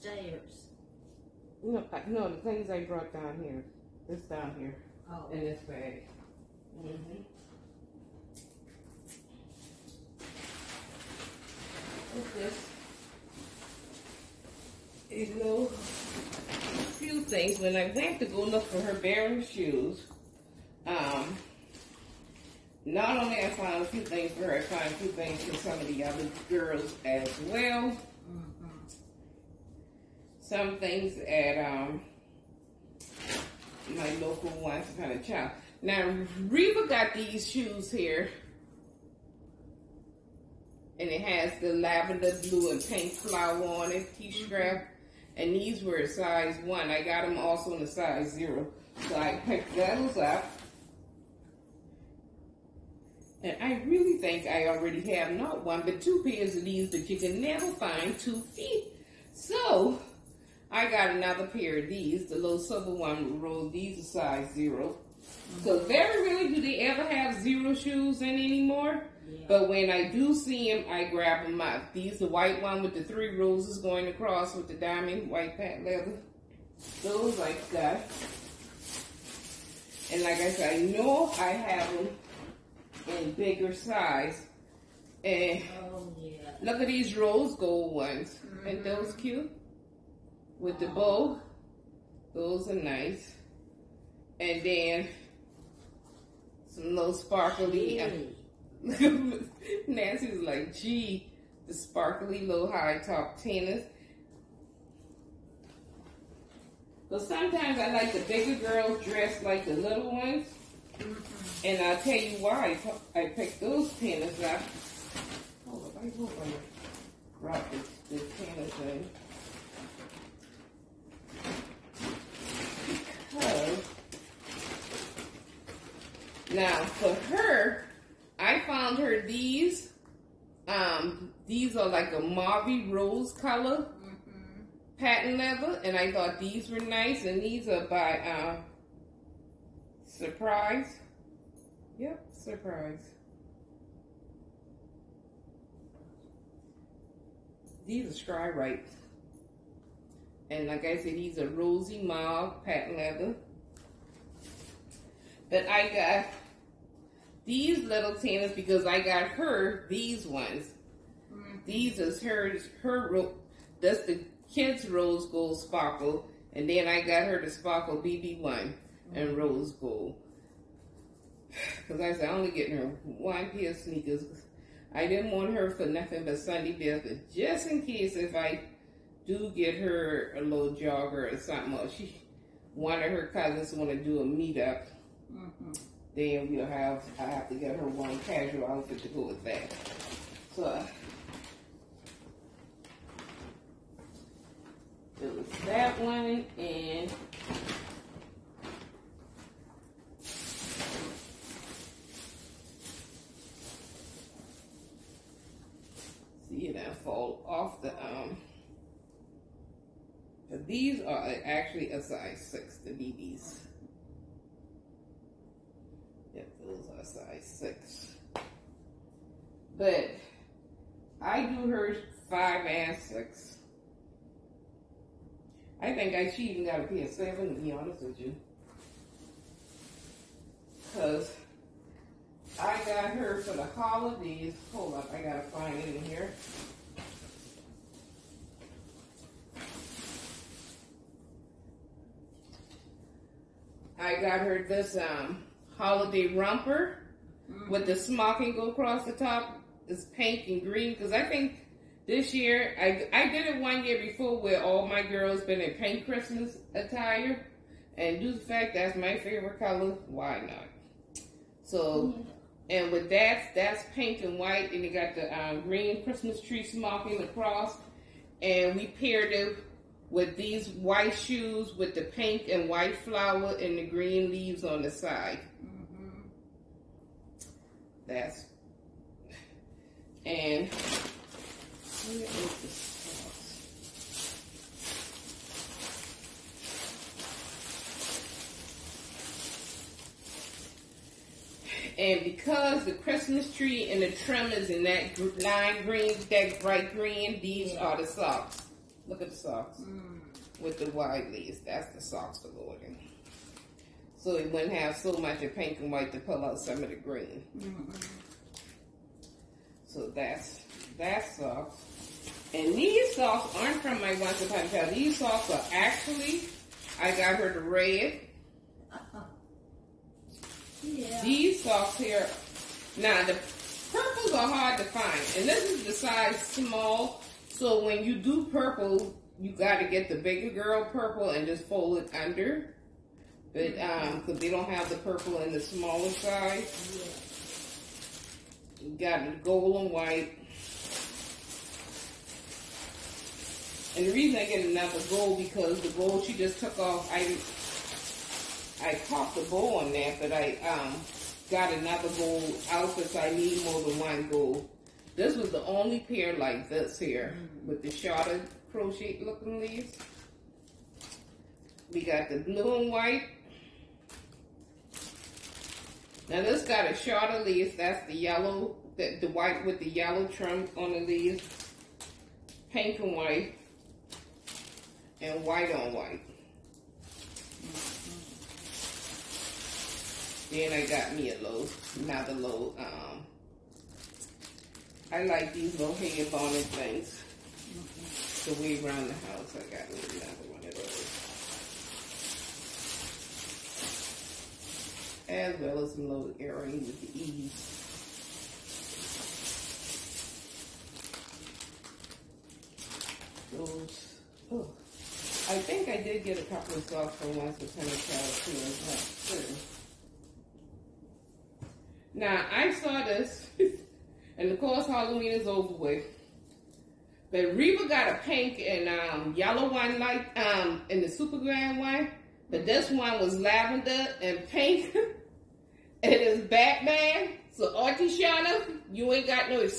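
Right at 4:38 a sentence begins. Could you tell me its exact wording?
That's and where is the sauce?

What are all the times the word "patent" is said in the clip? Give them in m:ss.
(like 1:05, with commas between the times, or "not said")
1:15, 2:14, 2:32.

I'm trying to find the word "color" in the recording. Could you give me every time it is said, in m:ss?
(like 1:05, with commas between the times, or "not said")
2:13, 4:19.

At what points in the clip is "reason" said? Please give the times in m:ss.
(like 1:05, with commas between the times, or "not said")
5:44.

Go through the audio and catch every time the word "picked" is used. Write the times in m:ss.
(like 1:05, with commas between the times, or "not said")
0:49, 1:53.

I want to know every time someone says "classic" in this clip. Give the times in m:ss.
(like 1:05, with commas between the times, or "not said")
not said.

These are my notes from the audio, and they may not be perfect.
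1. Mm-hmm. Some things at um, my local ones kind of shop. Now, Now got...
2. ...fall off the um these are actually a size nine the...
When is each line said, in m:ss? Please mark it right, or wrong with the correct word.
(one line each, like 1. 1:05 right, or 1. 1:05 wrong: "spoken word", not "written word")
1. 0:28 wrong: "Reva", not "Now"
2. 3:27 wrong: "six", not "nine".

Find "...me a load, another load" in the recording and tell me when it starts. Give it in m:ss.
6:21.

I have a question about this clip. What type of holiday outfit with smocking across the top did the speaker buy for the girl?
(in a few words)
romper.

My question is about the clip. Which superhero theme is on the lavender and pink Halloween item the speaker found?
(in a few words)
Batman.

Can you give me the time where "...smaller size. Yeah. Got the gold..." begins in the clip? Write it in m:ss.
5:35.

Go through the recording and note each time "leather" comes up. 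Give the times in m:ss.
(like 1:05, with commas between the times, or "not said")
1:15, 2:15, 2:32.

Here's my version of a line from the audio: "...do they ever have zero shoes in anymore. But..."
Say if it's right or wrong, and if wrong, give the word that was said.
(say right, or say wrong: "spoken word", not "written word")
right.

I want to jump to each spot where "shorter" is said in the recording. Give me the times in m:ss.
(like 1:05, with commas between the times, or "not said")
5:57, 6:06.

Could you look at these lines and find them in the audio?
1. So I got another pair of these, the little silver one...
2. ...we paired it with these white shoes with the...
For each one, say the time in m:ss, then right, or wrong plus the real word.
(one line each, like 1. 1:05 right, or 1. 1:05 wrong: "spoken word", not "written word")
1. 0:59 right
2. 4:28 right.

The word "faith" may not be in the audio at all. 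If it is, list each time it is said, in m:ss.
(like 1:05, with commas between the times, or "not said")
not said.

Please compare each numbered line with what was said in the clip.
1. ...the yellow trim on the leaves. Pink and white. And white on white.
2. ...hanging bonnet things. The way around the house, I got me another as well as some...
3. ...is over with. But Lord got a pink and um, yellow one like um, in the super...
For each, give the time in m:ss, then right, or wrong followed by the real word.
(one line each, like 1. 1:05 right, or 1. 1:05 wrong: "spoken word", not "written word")
1. 6:09 right
2. 6:25 right
3. 6:55 wrong: "Reba", not "Lord".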